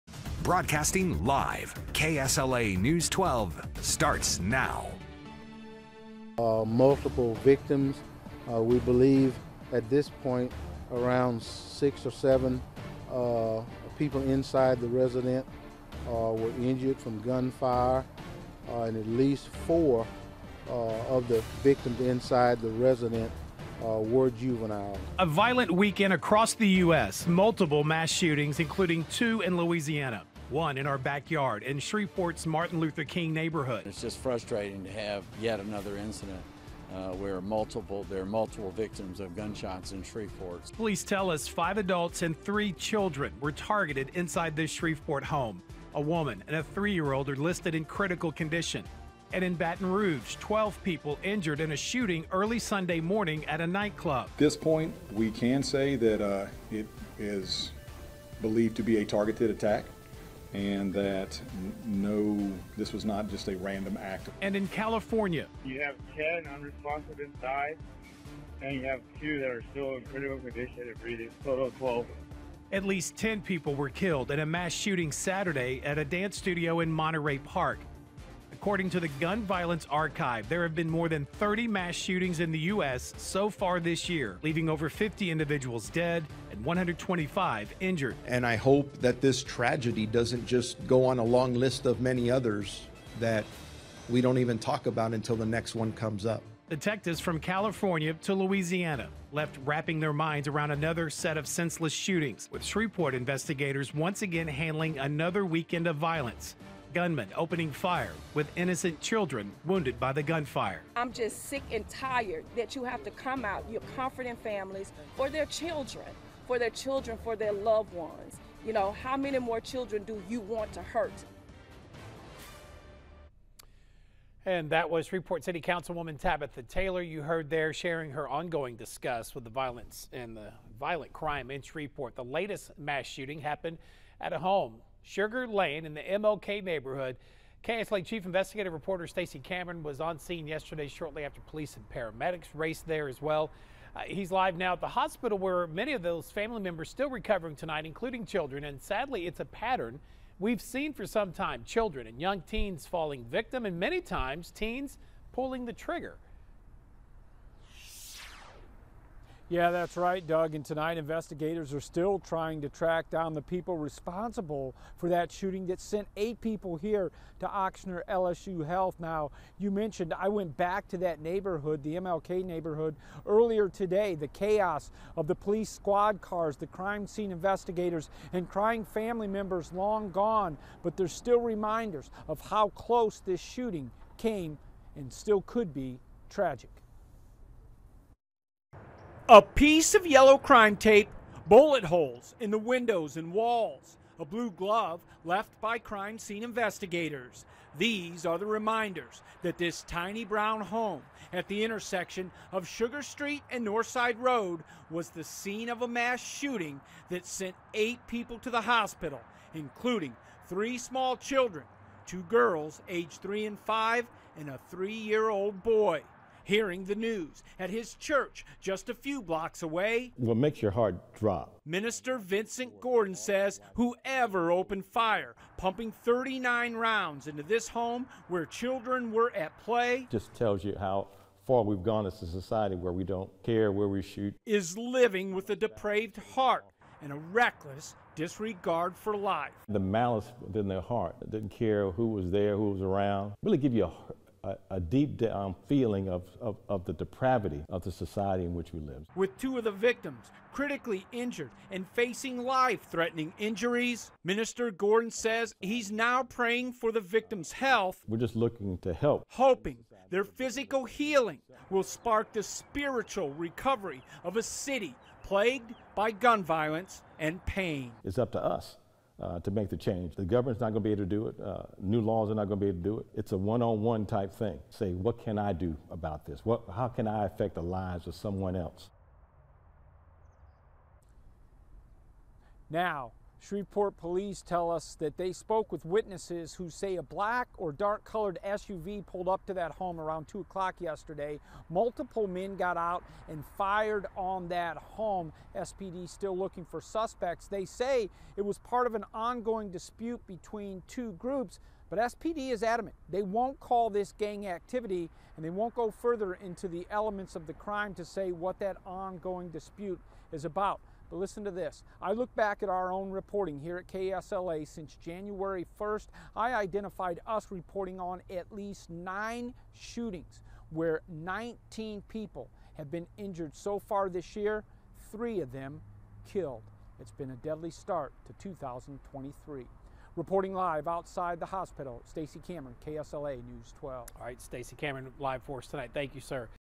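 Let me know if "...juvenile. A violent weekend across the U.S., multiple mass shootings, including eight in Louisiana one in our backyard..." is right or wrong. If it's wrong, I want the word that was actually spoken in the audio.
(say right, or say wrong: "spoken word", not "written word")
wrong: "two", not "eight".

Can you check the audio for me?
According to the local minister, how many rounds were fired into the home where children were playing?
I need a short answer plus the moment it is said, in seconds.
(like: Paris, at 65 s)
39, at 225 s.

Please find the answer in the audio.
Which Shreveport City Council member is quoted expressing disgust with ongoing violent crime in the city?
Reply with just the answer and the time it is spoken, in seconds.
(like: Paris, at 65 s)
Tabitha Taylor, at 126 s.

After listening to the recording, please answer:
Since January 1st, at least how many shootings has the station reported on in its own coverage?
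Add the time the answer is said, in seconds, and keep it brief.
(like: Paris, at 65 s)
9, at 318 s.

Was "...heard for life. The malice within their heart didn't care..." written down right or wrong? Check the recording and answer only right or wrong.
wrong.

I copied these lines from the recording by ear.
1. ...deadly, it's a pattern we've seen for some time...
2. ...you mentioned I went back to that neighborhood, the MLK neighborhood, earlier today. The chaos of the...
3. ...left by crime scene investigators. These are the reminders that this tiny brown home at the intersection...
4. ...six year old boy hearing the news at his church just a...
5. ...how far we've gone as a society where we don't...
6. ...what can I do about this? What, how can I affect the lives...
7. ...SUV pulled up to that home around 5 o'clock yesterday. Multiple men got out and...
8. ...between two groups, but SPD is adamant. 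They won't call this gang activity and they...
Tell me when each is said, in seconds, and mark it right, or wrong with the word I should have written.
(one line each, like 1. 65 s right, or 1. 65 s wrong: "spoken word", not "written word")
1. 148 s wrong: "sadly", not "deadly"
2. 169 s right
3. 195 s right
4. 214 s wrong: "three", not "six"
5. 230 s right
6. 274 s right
7. 288 s wrong: "2", not "5"
8. 300 s right.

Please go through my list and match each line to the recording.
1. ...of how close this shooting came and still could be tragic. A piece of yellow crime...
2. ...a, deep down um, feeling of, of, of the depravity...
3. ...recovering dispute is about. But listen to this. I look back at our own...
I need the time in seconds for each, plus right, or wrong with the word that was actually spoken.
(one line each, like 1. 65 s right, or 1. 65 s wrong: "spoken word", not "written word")
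1. 182 s right
2. 244 s right
3. 308 s wrong: "ongoing", not "recovering".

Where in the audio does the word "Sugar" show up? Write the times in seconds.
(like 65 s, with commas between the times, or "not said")
135 s, 202 s.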